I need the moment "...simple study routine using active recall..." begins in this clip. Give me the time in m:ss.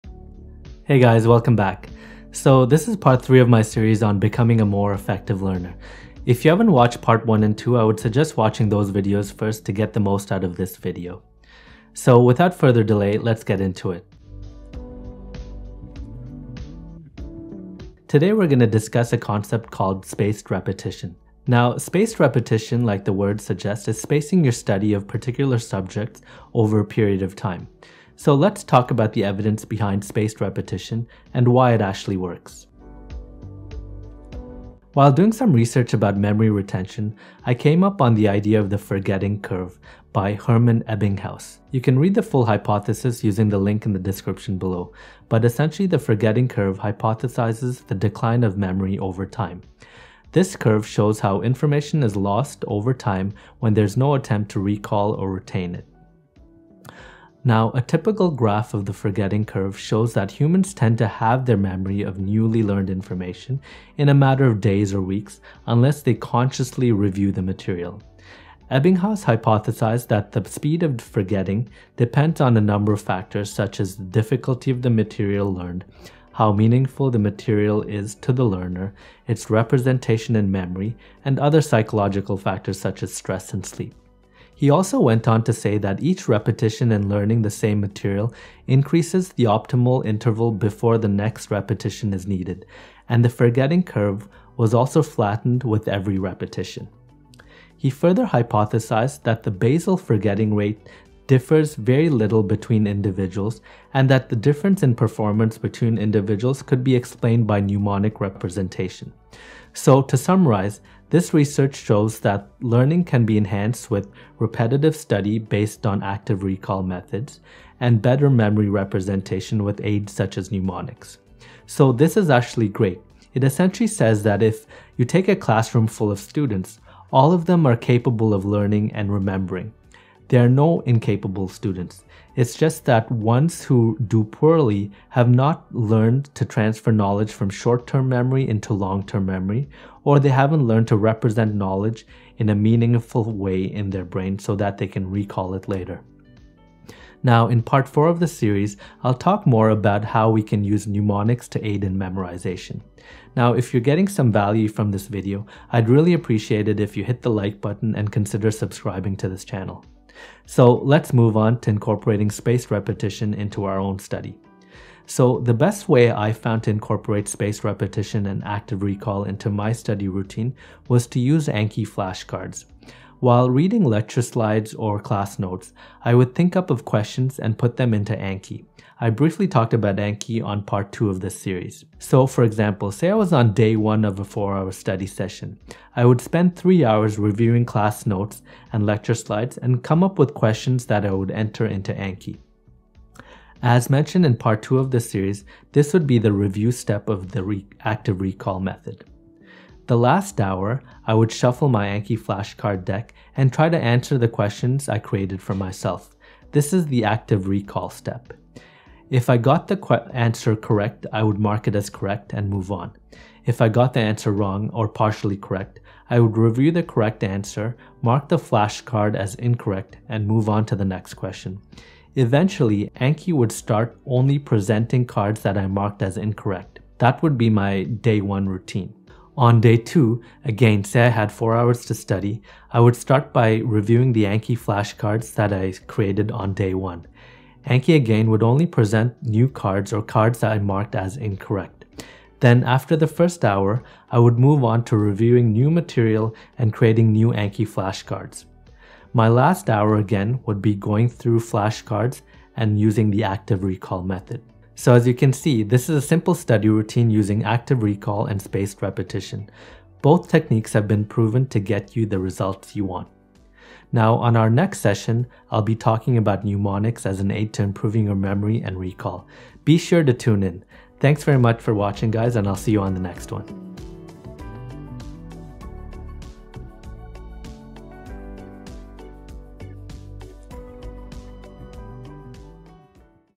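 4:16.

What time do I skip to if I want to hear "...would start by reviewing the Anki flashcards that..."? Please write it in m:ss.
3:52.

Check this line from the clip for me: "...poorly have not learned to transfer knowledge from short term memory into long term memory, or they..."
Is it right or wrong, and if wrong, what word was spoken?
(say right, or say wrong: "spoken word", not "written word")
right.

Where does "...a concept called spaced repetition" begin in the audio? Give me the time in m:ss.
0:19.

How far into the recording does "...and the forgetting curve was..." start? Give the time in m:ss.
1:33.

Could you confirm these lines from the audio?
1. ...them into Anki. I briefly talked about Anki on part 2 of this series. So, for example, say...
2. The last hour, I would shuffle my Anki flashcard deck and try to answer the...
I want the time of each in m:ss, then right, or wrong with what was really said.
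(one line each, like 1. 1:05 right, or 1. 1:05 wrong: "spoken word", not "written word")
1. 2:57 right
2. 3:19 right.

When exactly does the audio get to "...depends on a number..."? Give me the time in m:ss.
1:11.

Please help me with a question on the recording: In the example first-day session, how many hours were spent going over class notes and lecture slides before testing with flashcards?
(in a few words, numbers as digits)
3.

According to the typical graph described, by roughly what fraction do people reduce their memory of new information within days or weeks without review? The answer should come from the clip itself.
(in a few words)
halve.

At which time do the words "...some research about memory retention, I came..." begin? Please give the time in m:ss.
0:35.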